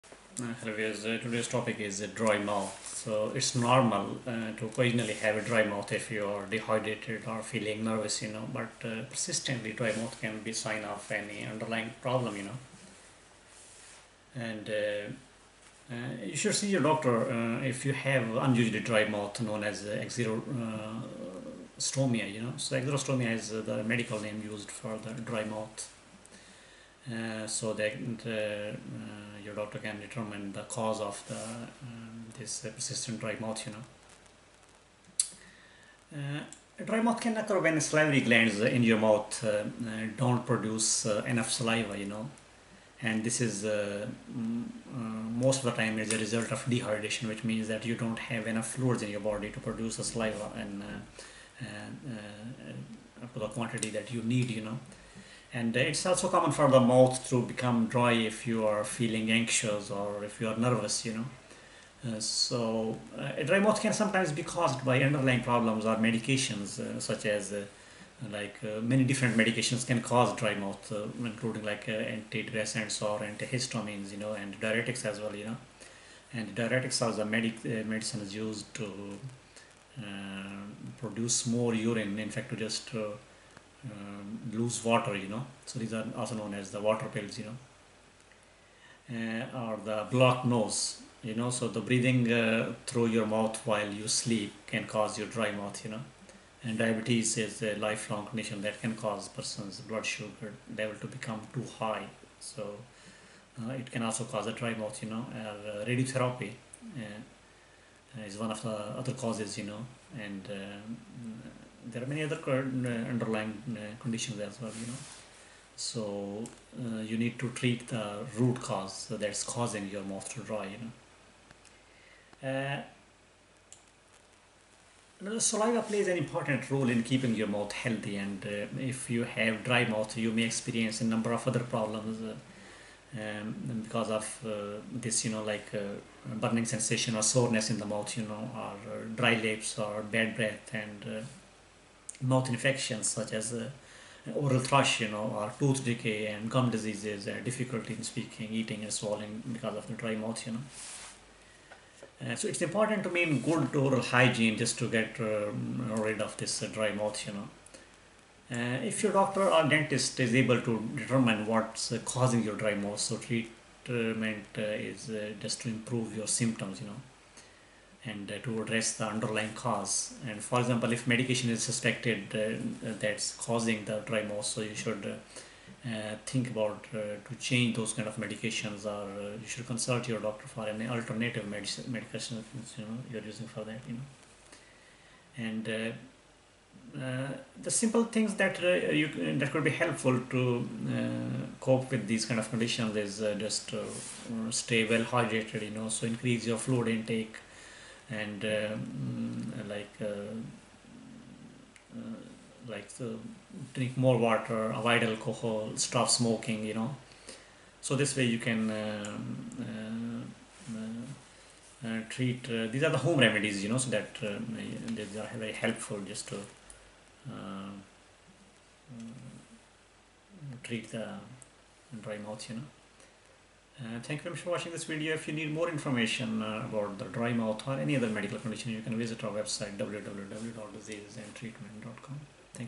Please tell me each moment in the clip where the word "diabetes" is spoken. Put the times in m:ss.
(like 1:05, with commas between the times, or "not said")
1:36.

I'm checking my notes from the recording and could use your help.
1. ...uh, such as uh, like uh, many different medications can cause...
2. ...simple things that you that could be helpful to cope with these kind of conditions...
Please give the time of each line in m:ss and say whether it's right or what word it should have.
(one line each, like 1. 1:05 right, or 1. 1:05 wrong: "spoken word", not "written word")
1. 1:06 right
2. 3:07 right.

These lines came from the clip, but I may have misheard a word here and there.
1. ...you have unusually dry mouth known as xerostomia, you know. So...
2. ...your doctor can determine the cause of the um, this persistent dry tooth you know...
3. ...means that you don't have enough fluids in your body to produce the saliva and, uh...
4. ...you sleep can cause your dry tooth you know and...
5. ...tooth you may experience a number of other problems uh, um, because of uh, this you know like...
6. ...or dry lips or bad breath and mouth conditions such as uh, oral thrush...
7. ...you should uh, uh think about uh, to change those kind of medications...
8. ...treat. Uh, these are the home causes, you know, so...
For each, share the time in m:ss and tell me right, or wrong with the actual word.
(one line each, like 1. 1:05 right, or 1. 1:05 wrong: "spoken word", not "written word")
1. 0:17 right
2. 0:29 wrong: "mouth", not "tooth"
3. 0:47 right
4. 1:33 wrong: "mouth", not "tooth"
5. 2:09 wrong: "mouth", not "tooth"
6. 2:18 wrong: "infections", not "conditions"
7. 2:54 right
8. 3:32 wrong: "remedies", not "causes".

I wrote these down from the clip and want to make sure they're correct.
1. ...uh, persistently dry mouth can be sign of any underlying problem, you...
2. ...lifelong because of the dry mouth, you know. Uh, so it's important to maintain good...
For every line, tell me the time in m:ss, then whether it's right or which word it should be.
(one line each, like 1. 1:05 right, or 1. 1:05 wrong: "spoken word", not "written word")
1. 0:08 right
2. 2:28 wrong: "swallowing", not "lifelong".